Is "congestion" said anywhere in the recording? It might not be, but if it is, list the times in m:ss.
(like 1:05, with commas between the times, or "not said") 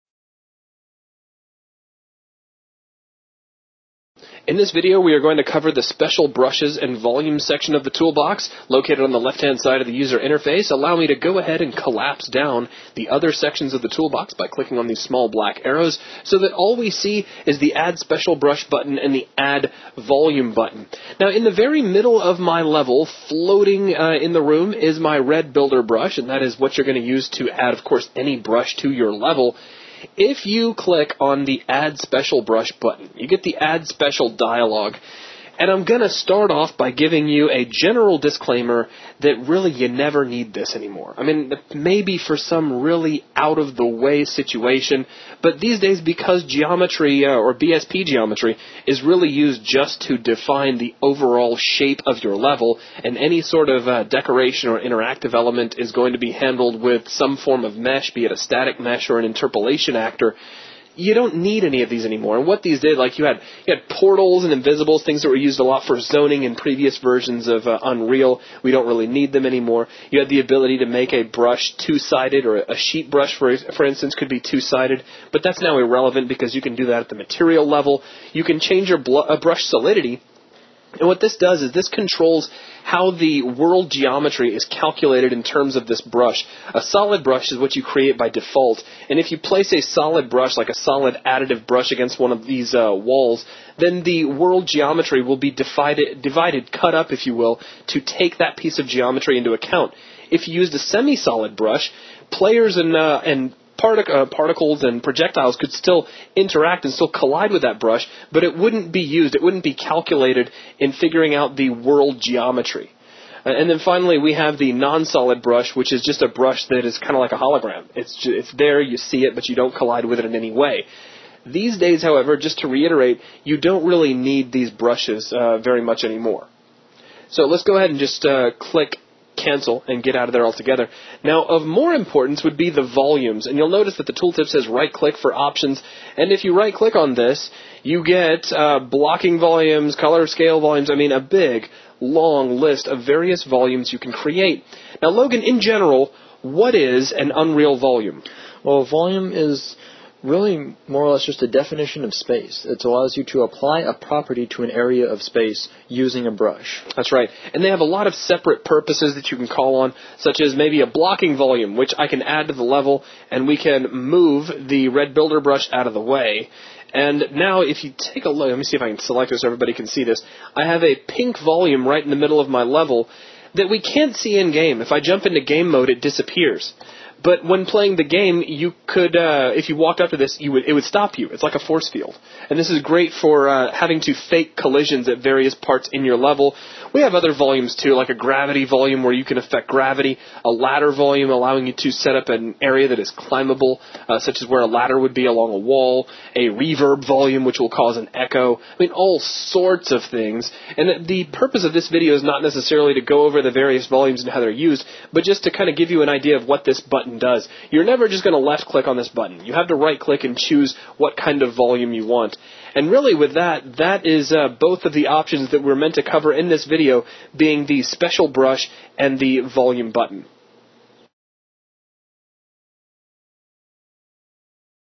not said.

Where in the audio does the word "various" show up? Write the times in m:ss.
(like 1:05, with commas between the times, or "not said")
2:23, 3:05, 3:23.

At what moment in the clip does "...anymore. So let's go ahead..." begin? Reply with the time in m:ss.
2:06.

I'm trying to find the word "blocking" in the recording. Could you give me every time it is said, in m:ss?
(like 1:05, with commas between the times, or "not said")
2:18, 2:40.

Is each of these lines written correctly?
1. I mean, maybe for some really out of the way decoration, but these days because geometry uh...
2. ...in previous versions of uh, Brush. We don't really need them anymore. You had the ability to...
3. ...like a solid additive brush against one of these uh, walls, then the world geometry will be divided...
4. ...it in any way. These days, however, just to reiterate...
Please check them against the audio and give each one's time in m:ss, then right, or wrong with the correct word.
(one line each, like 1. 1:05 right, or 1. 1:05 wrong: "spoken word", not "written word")
1. 0:41 wrong: "situation", not "decoration"
2. 1:06 wrong: "Unreal", not "Brush"
3. 1:30 right
4. 2:00 right.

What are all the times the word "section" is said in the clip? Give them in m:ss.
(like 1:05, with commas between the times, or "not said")
0:07, 0:13.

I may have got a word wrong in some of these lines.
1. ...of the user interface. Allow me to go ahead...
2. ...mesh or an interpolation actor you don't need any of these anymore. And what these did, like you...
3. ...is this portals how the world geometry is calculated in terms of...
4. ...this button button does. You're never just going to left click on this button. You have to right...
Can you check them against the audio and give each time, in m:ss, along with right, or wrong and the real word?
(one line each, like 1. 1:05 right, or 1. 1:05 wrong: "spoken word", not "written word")
1. 0:09 right
2. 0:58 right
3. 1:21 wrong: "controls", not "portals"
4. 3:26 right.